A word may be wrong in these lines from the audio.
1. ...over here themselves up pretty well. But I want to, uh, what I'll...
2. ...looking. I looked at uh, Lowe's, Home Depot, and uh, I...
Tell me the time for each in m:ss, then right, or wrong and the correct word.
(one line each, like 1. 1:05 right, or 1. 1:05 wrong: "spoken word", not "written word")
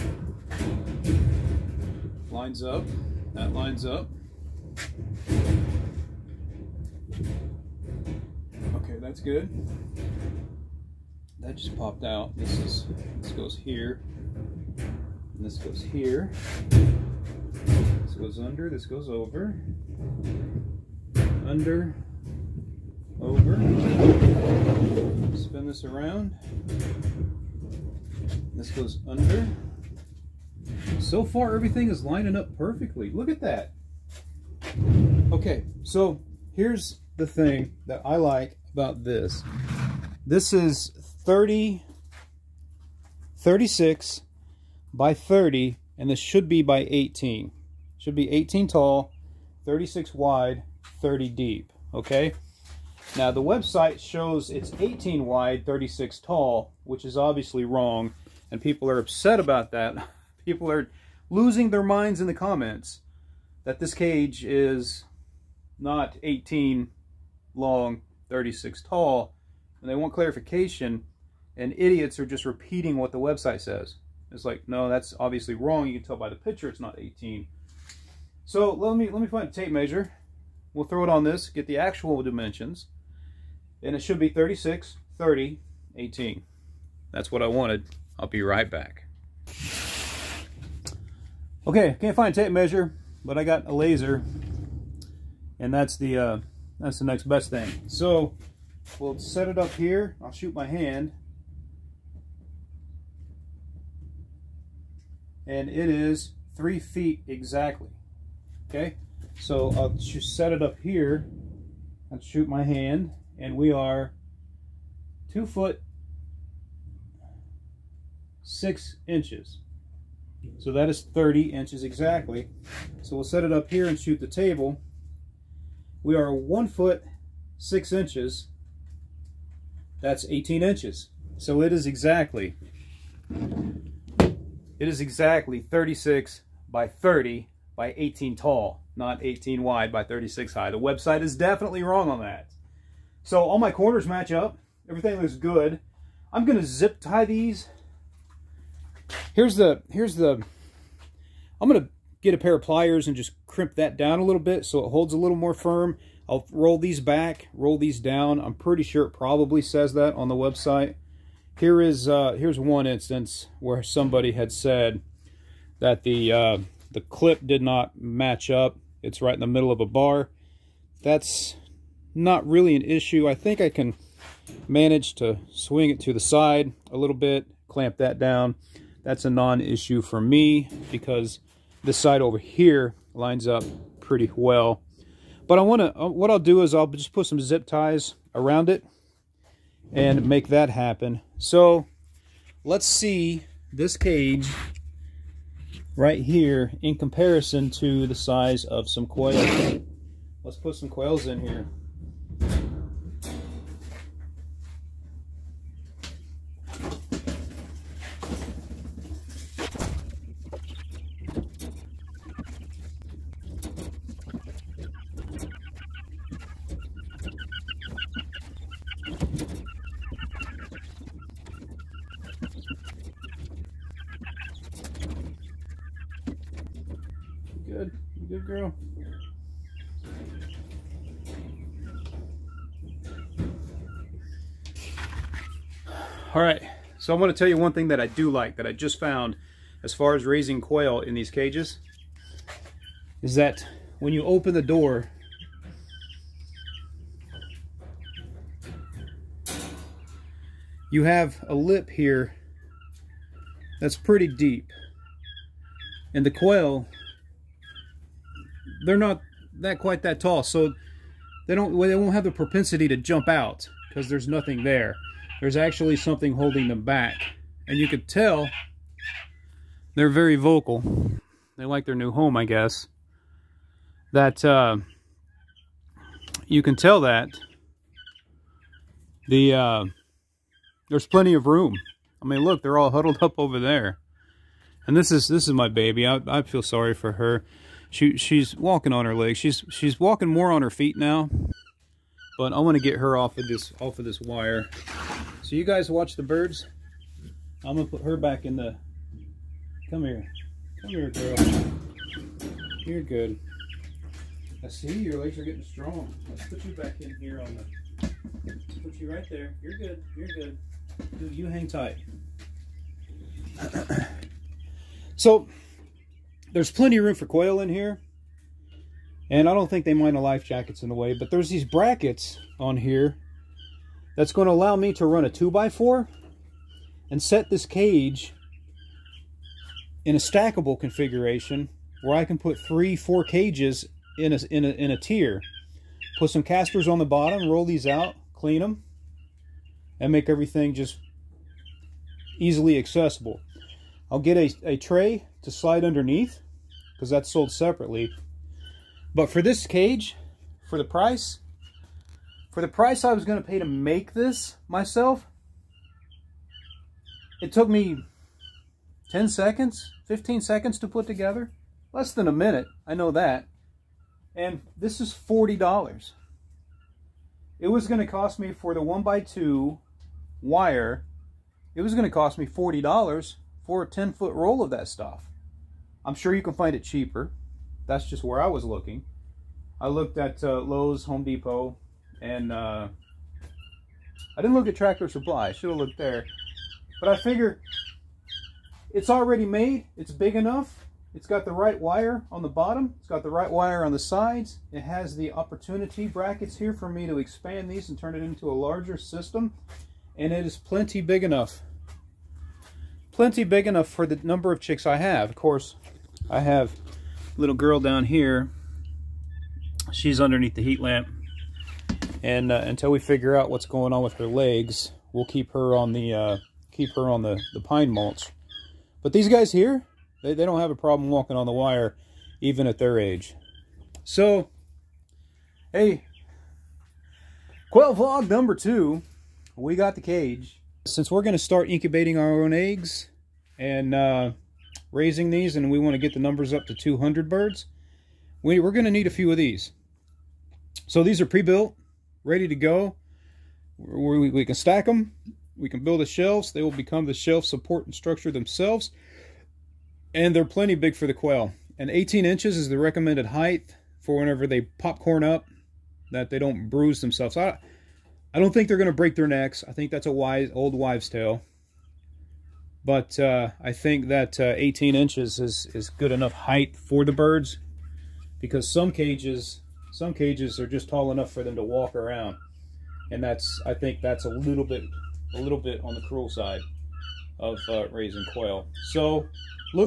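1. 3:02 wrong: "lines", not "themselves"
2. 6:18 right.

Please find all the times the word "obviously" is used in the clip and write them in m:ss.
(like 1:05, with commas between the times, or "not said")
0:57, 1:15.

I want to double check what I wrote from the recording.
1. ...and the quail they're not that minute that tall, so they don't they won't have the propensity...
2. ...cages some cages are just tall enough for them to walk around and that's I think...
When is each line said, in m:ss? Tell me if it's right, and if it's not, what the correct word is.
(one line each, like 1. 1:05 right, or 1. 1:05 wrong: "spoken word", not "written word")
1. 4:16 wrong: "quite", not "minute"
2. 7:48 right.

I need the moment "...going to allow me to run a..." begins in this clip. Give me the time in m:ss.
5:24.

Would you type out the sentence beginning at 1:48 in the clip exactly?
Okay, so I'll just set it up here and shoot my hand.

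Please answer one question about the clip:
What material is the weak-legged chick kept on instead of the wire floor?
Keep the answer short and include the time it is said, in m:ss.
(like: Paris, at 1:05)
pine mulch, at 6:57.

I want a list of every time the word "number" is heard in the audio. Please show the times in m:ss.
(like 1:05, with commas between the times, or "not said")
6:44, 7:08, 7:16.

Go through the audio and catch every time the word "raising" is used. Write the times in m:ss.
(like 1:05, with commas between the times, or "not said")
4:00, 7:14, 7:57.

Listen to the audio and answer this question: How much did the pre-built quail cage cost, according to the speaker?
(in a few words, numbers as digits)
$40.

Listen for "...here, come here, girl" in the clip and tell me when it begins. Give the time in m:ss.
5:00.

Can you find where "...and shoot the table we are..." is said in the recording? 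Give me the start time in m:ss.
2:03.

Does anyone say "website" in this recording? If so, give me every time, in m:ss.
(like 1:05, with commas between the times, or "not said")
0:53, 1:13, 2:20, 2:40.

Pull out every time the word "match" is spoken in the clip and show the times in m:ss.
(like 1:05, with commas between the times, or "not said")
2:24, 2:47.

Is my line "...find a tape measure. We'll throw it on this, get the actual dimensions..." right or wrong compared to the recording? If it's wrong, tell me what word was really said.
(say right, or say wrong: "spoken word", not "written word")
right.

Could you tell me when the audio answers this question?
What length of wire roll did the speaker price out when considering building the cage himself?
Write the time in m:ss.
6:13.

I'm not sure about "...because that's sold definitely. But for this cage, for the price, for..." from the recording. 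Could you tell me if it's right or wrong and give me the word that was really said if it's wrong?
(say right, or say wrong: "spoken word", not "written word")
wrong: "separately", not "definitely".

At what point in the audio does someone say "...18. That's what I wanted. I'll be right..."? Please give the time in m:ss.
1:25.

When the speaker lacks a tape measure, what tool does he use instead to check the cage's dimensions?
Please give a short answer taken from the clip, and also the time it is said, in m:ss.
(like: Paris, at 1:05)
a laser, at 1:33.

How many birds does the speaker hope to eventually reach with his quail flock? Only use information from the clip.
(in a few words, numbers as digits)
200.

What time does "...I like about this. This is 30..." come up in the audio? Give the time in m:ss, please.
0:38.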